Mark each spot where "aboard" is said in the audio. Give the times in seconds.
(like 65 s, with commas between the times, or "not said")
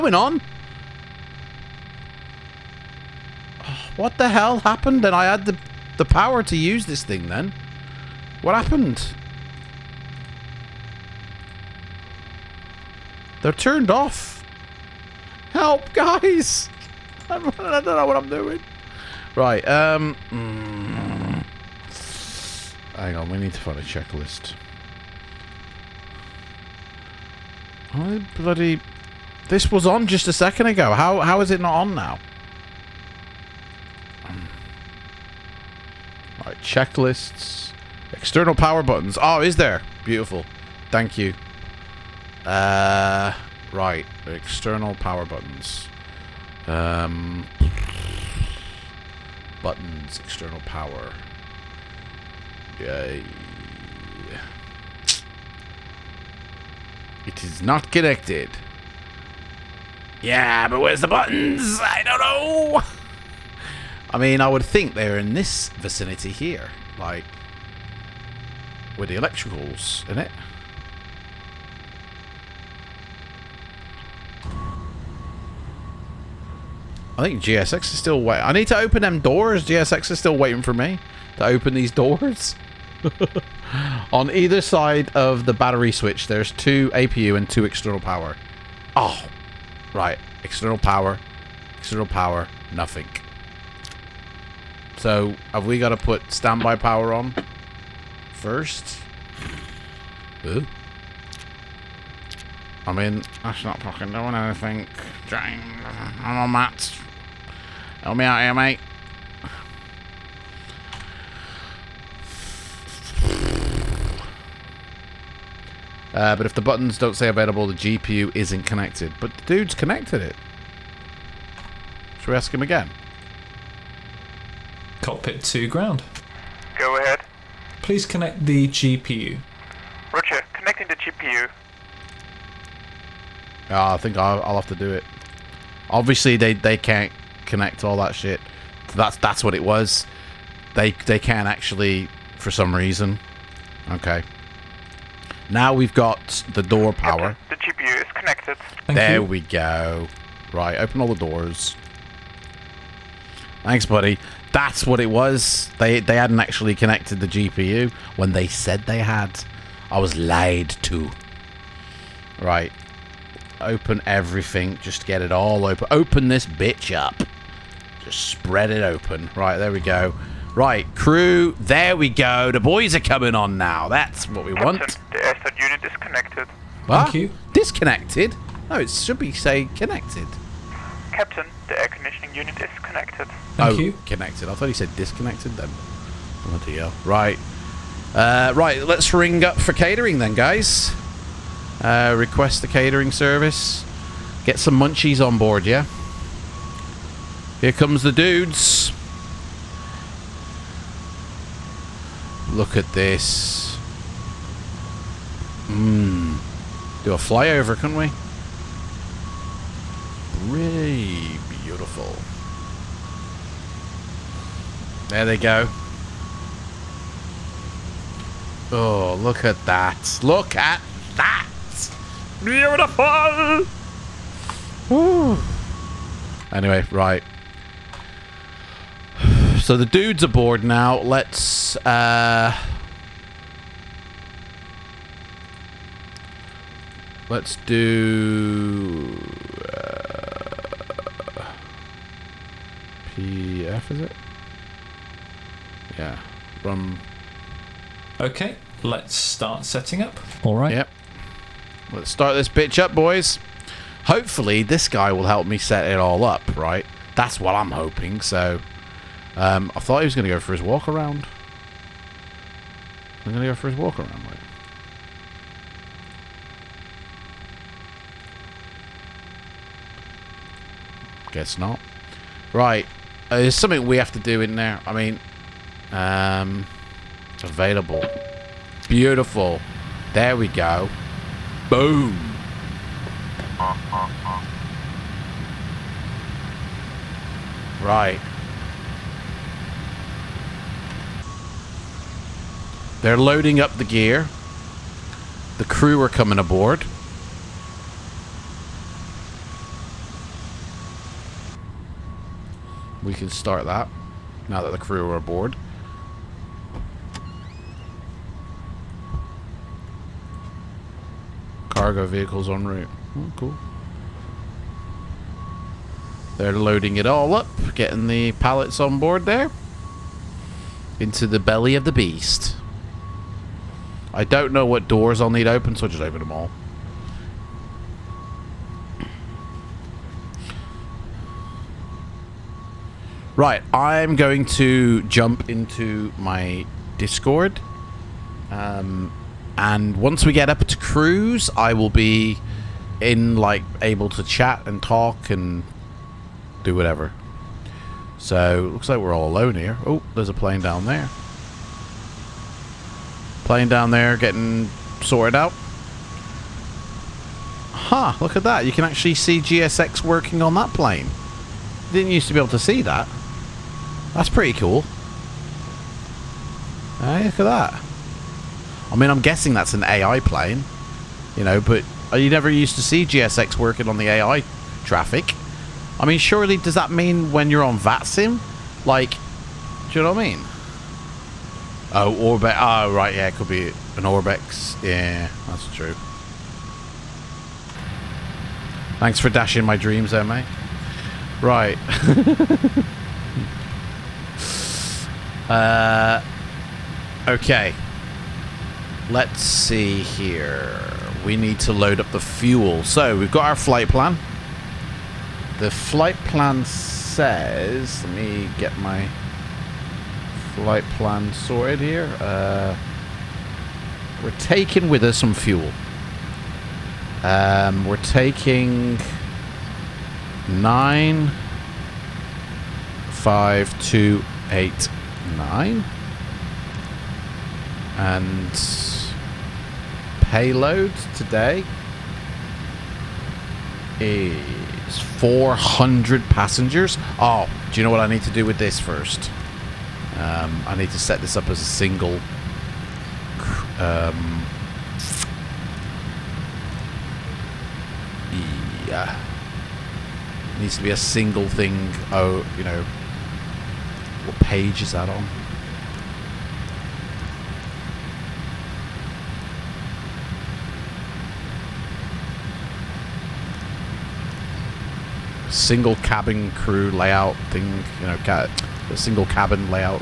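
230 s, 296 s, 305 s.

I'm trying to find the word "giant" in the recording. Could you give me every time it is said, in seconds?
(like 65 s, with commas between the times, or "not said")
not said.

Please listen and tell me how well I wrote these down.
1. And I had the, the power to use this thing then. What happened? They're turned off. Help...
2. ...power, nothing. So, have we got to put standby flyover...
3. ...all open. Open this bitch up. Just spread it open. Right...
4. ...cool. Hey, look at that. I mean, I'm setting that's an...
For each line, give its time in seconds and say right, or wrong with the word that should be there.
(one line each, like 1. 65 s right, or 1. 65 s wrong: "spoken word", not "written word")
1. 5 s right
2. 92 s wrong: "power", not "flyover"
3. 165 s right
4. 364 s wrong: "guessing", not "setting".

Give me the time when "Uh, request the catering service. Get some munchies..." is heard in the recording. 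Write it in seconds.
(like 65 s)
191 s.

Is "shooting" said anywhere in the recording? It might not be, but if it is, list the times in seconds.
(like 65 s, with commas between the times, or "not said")
not said.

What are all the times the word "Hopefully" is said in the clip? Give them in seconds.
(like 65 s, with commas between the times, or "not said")
254 s.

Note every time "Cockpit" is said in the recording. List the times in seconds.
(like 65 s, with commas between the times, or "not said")
125 s.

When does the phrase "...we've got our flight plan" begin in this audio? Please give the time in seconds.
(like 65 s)
403 s.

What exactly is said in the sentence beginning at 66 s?
Like, where the electrical's, in it?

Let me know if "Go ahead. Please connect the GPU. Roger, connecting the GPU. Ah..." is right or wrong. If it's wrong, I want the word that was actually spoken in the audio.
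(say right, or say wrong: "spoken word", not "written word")
right.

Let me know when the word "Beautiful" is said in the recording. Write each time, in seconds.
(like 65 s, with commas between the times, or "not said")
40 s, 211 s, 222 s, 278 s.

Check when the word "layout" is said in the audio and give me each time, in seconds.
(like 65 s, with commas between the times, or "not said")
466 s.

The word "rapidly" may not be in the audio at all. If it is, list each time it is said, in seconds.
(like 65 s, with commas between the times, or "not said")
not said.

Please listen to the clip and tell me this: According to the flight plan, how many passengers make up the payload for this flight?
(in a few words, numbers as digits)
400.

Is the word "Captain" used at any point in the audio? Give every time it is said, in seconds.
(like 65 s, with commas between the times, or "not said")
181 s.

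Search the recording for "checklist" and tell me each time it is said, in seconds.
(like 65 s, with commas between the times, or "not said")
23 s, 36 s.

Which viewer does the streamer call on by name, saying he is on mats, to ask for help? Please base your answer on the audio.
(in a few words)
James.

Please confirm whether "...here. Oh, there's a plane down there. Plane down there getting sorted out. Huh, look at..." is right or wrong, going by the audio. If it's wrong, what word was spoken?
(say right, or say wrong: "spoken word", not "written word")
right.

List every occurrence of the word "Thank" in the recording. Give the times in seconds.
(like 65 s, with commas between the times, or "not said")
40 s, 148 s, 153 s, 177 s, 183 s, 388 s.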